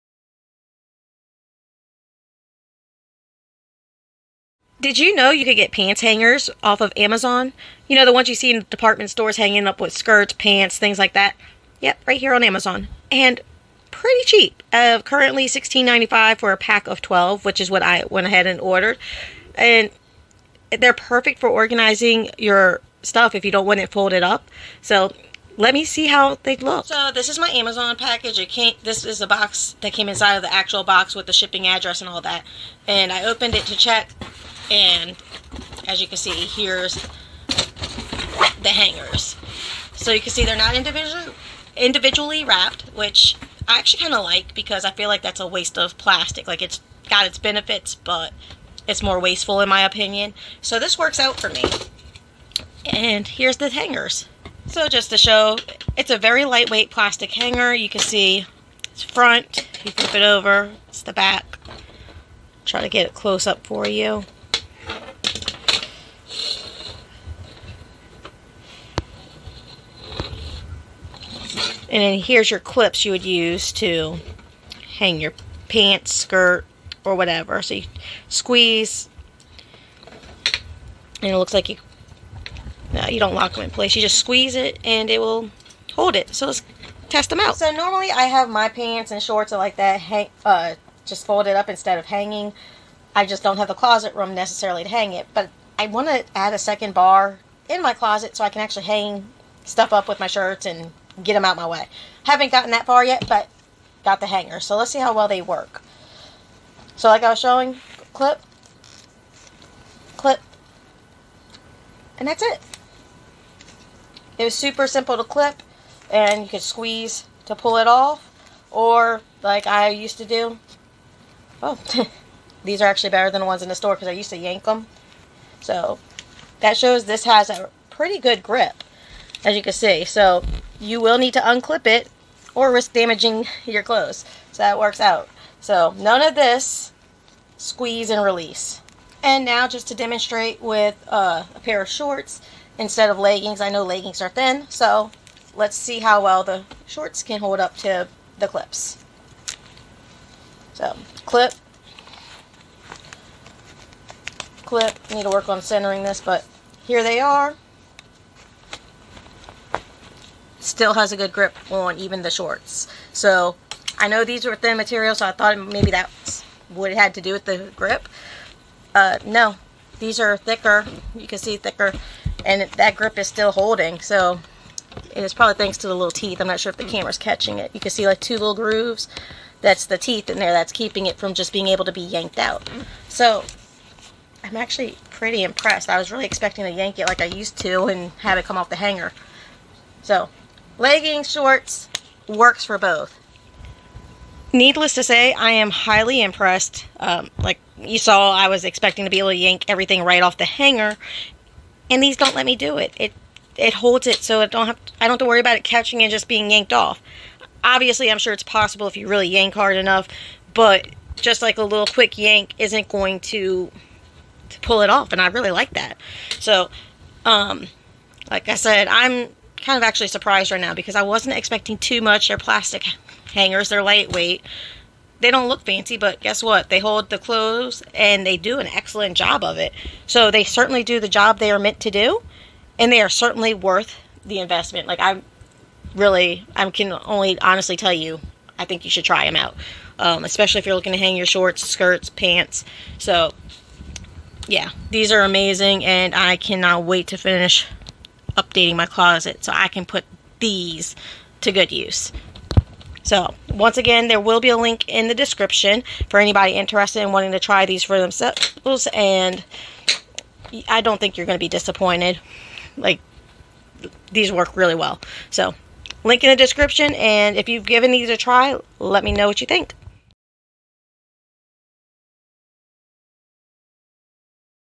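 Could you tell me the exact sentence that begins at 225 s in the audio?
They don't look fancy, but guess what?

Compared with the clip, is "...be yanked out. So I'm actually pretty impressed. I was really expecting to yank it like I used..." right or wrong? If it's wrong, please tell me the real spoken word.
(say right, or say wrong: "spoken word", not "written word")
right.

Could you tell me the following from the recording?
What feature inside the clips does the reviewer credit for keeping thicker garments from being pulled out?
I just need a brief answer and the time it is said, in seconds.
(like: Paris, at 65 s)
little teeth, at 175 s.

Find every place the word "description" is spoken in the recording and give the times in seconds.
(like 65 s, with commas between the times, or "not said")
255 s, 266 s.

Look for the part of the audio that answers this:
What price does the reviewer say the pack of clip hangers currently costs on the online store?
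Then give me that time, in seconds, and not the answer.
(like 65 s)
15 s.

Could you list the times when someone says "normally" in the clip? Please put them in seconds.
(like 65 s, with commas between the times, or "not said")
87 s.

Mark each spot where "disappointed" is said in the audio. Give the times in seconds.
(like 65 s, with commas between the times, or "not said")
261 s.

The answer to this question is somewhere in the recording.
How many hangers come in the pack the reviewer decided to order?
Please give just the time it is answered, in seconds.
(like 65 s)
16 s.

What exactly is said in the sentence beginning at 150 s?
So clip, clip, need to work on centering this, but here they are still has a good grip on even the shorts.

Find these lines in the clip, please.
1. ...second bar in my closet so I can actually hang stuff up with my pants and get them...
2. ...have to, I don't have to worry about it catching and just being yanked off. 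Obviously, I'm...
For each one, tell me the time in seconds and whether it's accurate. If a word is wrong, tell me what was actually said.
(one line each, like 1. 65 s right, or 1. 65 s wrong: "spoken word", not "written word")
1. 96 s wrong: "shirts", not "pants"
2. 204 s right.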